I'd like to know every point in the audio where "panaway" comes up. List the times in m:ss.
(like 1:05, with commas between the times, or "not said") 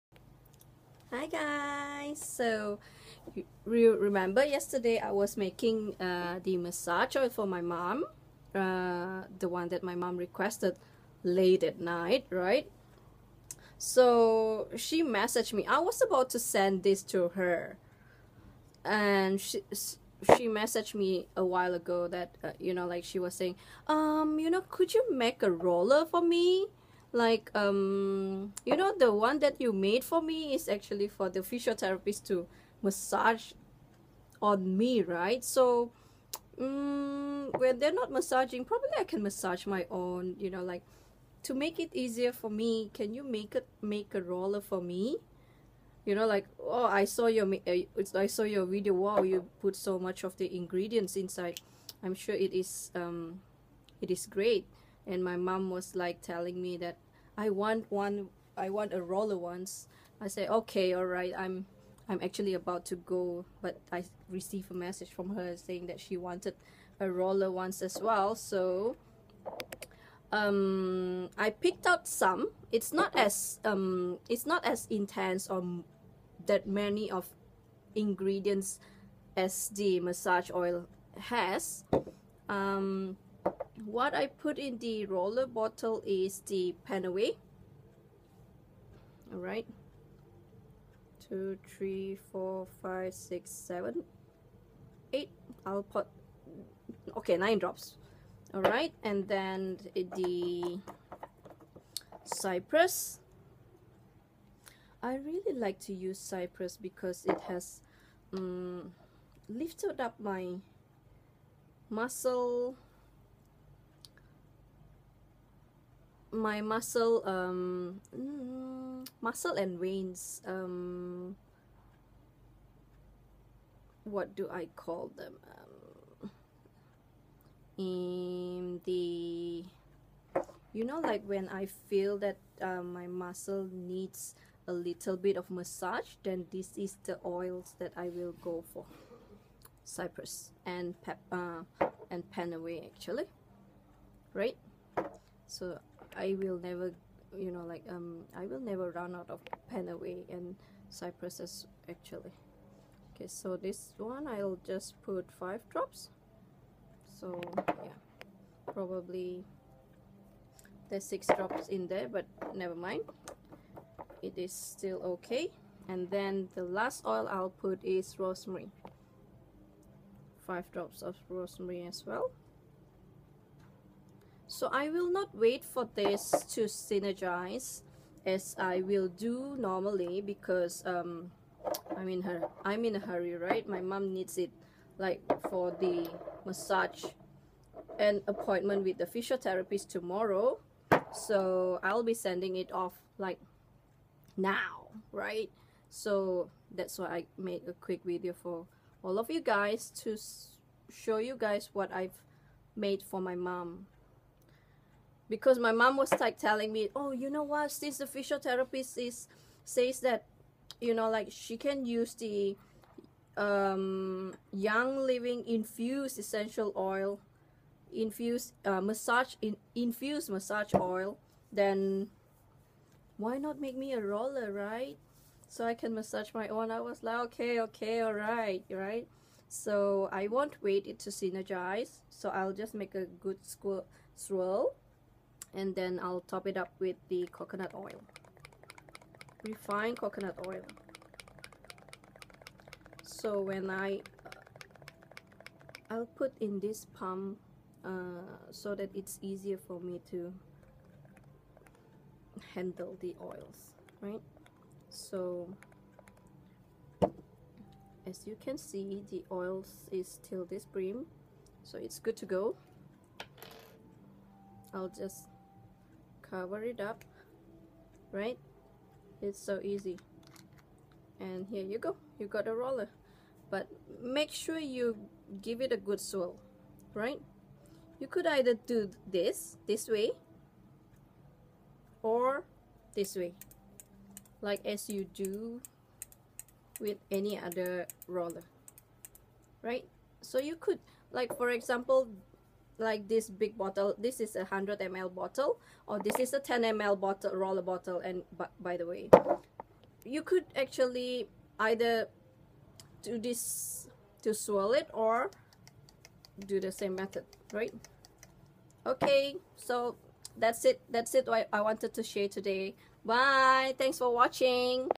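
1:26, 2:22, 2:29.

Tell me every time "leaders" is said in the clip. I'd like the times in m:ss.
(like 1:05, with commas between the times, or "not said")
not said.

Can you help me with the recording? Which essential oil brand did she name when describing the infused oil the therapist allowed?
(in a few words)
Young Living.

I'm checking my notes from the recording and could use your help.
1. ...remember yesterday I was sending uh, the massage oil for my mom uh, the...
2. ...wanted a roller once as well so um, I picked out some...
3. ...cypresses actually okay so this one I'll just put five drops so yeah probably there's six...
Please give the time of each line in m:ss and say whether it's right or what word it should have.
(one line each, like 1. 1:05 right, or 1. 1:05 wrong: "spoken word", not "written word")
1. 0:03 wrong: "making", not "sending"
2. 1:06 right
3. 2:30 right.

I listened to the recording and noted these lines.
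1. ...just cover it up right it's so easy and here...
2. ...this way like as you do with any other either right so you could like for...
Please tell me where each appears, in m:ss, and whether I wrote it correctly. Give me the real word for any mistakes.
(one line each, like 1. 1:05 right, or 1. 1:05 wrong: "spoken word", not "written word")
1. 4:24 right
2. 4:42 wrong: "roller", not "either".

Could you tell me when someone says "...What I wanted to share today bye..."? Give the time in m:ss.
5:11.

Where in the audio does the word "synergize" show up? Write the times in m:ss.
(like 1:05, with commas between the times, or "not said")
2:56, 3:51.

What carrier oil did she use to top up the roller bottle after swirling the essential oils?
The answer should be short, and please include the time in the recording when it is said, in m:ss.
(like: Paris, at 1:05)
Refined coconut oil, at 3:59.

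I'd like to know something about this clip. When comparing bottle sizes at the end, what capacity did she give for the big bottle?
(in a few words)
100 ml.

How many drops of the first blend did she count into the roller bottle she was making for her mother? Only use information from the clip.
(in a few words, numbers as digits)
9.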